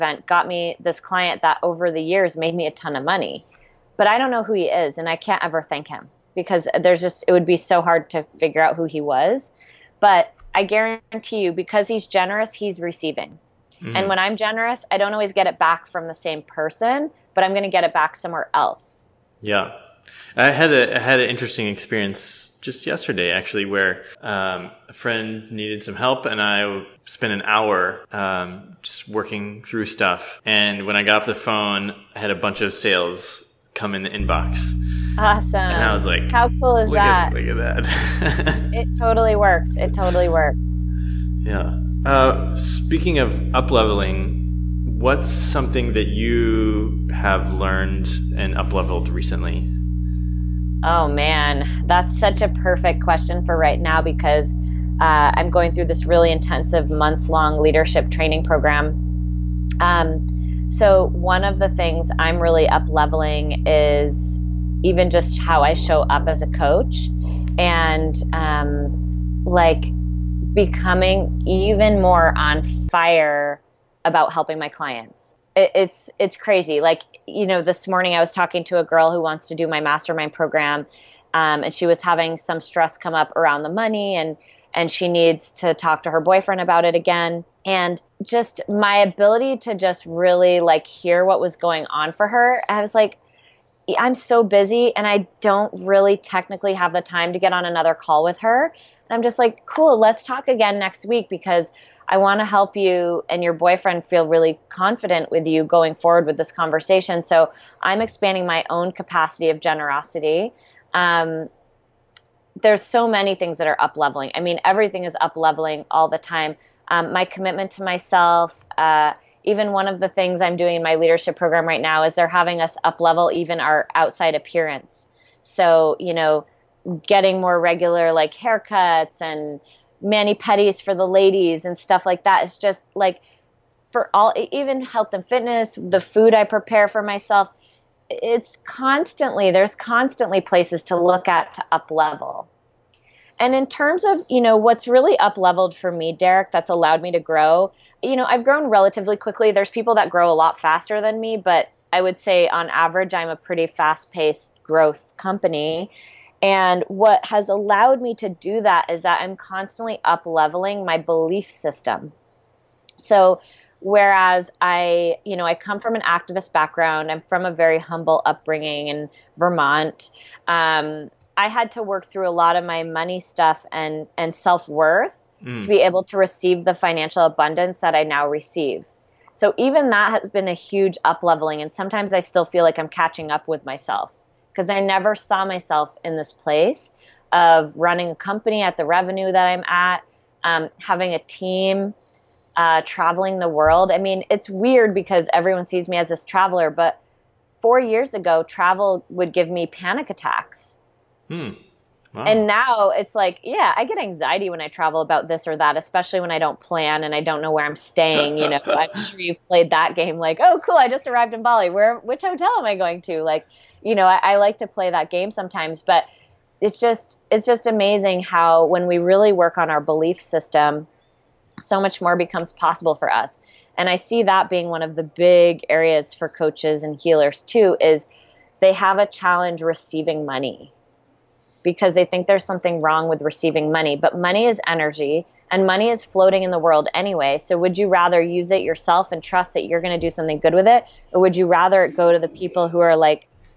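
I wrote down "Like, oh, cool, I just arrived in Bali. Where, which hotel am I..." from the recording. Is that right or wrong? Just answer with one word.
right.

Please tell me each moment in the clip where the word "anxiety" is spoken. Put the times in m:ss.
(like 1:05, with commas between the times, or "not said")
3:23.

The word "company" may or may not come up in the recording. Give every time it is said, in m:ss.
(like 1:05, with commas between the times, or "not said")
2:35, 3:08.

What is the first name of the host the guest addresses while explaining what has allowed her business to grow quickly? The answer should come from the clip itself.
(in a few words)
Derek.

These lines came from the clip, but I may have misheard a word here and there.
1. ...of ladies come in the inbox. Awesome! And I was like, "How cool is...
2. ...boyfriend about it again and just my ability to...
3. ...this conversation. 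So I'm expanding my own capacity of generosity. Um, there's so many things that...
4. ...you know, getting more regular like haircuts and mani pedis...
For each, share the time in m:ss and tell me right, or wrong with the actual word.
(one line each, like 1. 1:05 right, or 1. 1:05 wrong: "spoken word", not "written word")
1. 0:32 wrong: "sales", not "ladies"
2. 1:26 right
3. 1:46 right
4. 2:05 right.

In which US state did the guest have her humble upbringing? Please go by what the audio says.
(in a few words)
Vermont.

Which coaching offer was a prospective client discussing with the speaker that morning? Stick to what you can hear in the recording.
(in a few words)
mastermind program.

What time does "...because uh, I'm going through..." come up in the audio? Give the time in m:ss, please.
0:54.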